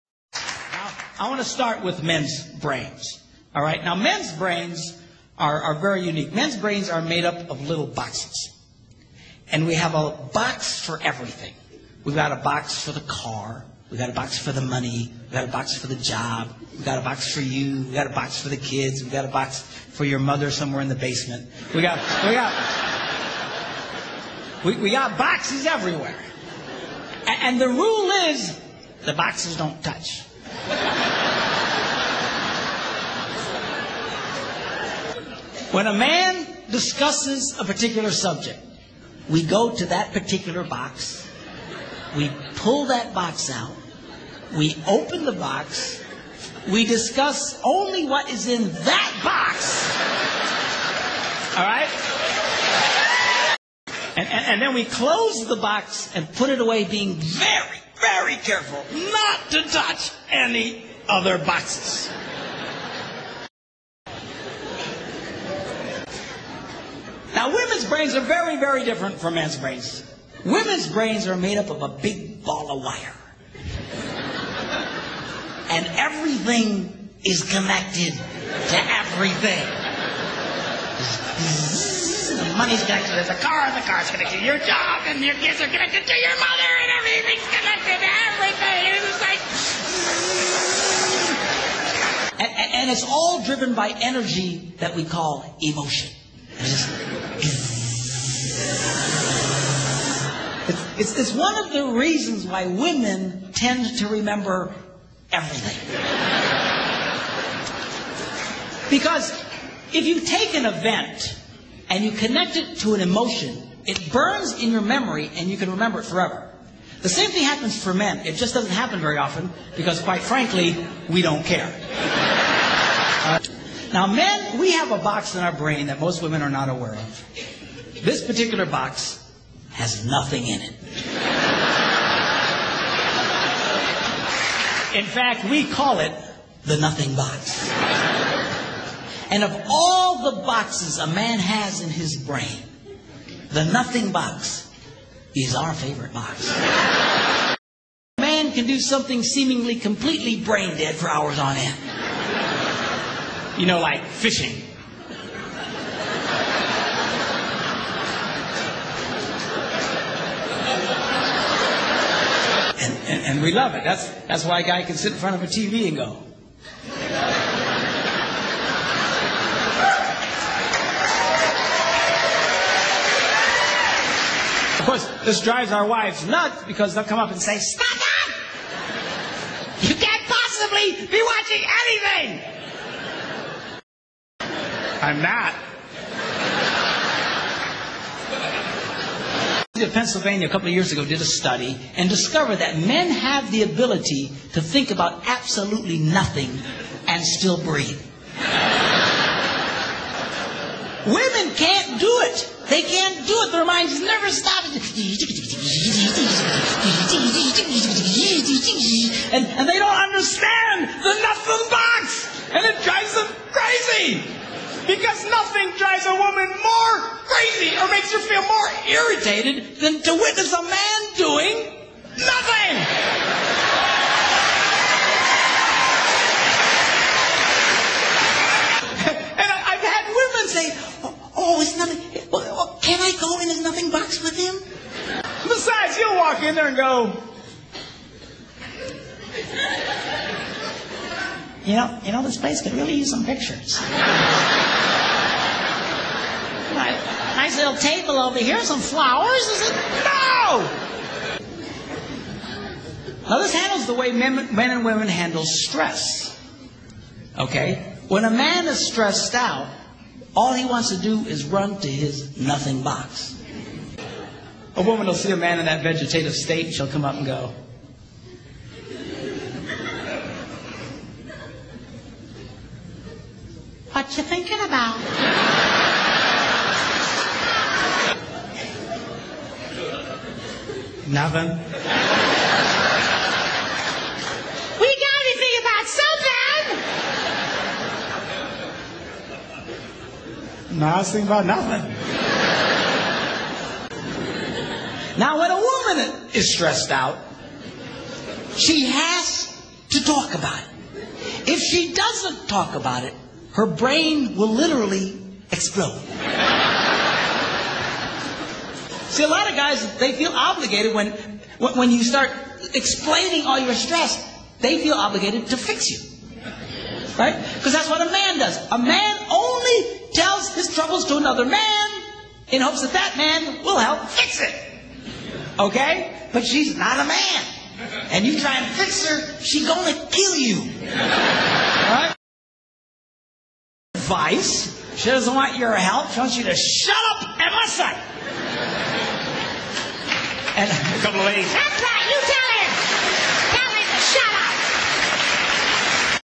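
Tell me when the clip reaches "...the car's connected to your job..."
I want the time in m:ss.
1:23.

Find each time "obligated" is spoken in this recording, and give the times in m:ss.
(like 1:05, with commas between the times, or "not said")
5:10, 5:14.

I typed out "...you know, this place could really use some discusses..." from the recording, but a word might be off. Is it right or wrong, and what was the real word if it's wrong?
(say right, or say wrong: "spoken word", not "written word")
wrong: "pictures", not "discusses".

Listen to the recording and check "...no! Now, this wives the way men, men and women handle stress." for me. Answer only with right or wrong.
wrong.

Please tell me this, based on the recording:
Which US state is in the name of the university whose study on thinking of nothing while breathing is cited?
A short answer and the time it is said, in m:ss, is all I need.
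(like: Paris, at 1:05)
Pennsylvania, at 3:09.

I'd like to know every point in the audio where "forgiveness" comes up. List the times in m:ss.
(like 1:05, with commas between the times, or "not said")
not said.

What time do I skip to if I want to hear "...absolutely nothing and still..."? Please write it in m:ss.
3:15.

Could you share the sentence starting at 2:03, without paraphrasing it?
Now, men, we have a box in our brain that most women are not aware of.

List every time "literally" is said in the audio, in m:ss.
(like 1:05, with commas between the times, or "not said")
5:04.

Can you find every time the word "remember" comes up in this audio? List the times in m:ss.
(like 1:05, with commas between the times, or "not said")
1:44, 1:55.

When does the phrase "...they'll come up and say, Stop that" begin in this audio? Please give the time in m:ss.
2:56.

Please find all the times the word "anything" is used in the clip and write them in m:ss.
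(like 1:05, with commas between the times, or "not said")
3:01, 4:45.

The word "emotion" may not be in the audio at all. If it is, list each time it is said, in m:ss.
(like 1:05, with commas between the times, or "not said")
1:35, 1:53.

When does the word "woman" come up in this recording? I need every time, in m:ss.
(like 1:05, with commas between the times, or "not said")
3:36, 4:24, 4:55.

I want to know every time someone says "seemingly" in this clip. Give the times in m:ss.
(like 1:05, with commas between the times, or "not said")
2:29.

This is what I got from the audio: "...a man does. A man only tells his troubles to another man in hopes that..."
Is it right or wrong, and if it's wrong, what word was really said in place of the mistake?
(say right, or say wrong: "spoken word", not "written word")
right.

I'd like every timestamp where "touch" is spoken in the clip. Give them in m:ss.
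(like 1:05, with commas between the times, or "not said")
0:29, 0:59.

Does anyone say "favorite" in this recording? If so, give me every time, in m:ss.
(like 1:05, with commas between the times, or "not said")
2:25.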